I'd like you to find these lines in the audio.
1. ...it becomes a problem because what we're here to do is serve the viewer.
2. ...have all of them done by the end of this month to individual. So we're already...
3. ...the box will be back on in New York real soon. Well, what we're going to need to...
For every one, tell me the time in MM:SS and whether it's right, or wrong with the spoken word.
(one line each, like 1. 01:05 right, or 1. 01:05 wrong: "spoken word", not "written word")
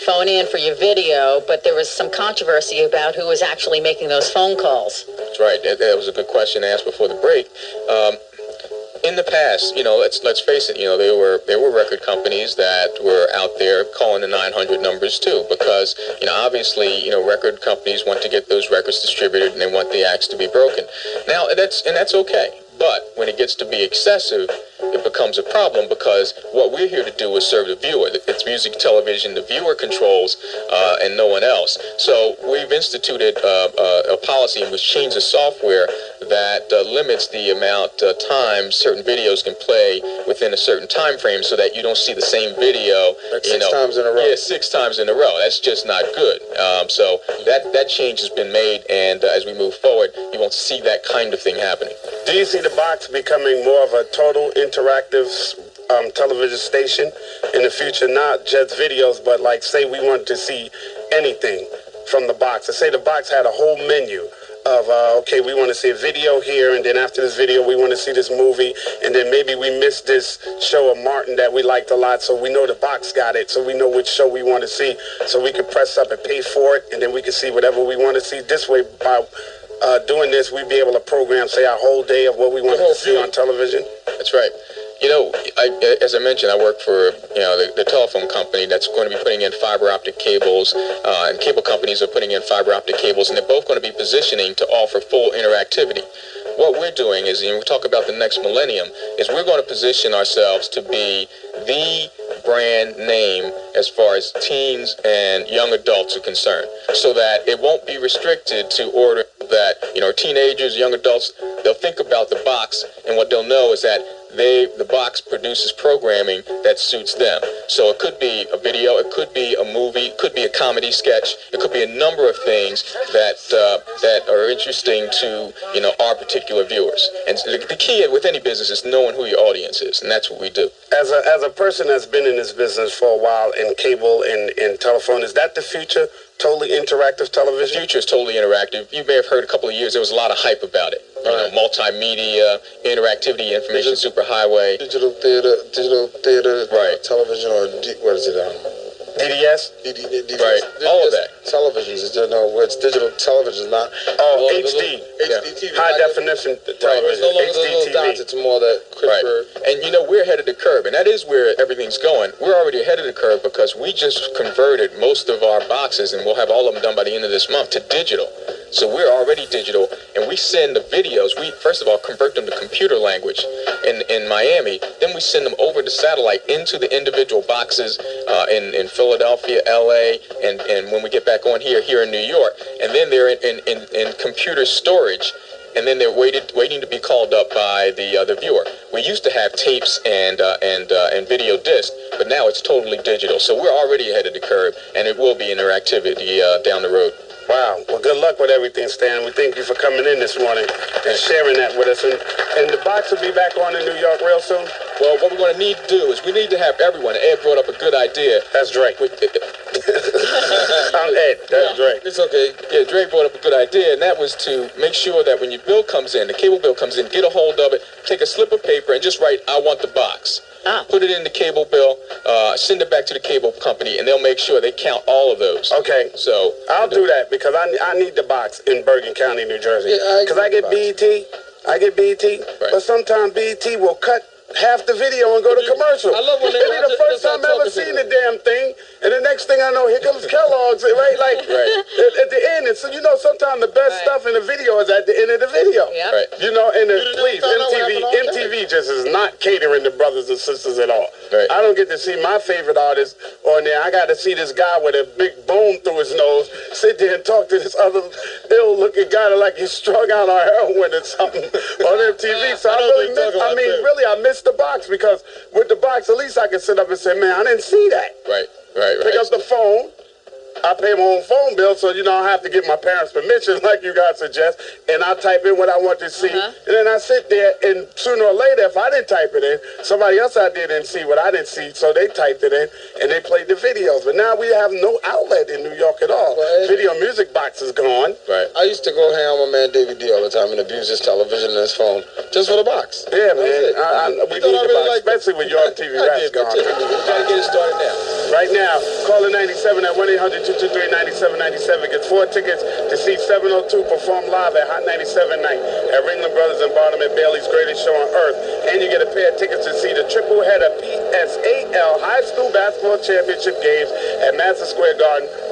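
1. 00:24 right
2. 02:46 wrong: "digital", not "individual"
3. 03:22 right.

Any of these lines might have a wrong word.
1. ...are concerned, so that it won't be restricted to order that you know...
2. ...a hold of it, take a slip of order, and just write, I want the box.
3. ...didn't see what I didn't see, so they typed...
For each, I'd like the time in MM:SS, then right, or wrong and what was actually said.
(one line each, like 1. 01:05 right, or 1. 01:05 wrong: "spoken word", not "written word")
1. 01:46 right
2. 03:37 wrong: "paper", not "order"
3. 04:40 right.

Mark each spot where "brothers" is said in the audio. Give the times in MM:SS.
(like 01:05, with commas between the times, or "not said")
04:09, 05:06.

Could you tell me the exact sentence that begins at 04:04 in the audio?
stuff in the video is at the end of the video.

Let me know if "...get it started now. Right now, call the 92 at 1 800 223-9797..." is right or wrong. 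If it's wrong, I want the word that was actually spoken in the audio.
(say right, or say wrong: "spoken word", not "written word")
wrong: "97", not "92".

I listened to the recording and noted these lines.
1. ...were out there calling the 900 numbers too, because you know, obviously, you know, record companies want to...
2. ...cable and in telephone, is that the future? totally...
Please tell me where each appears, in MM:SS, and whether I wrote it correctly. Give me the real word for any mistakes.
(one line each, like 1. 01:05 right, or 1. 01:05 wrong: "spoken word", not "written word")
1. 00:13 right
2. 02:13 right.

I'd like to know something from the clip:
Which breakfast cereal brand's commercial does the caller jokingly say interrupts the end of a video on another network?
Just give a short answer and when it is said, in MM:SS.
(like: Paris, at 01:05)
Kellogg's, at 04:00.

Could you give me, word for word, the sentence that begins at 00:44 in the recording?
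Yeah, six times in a row.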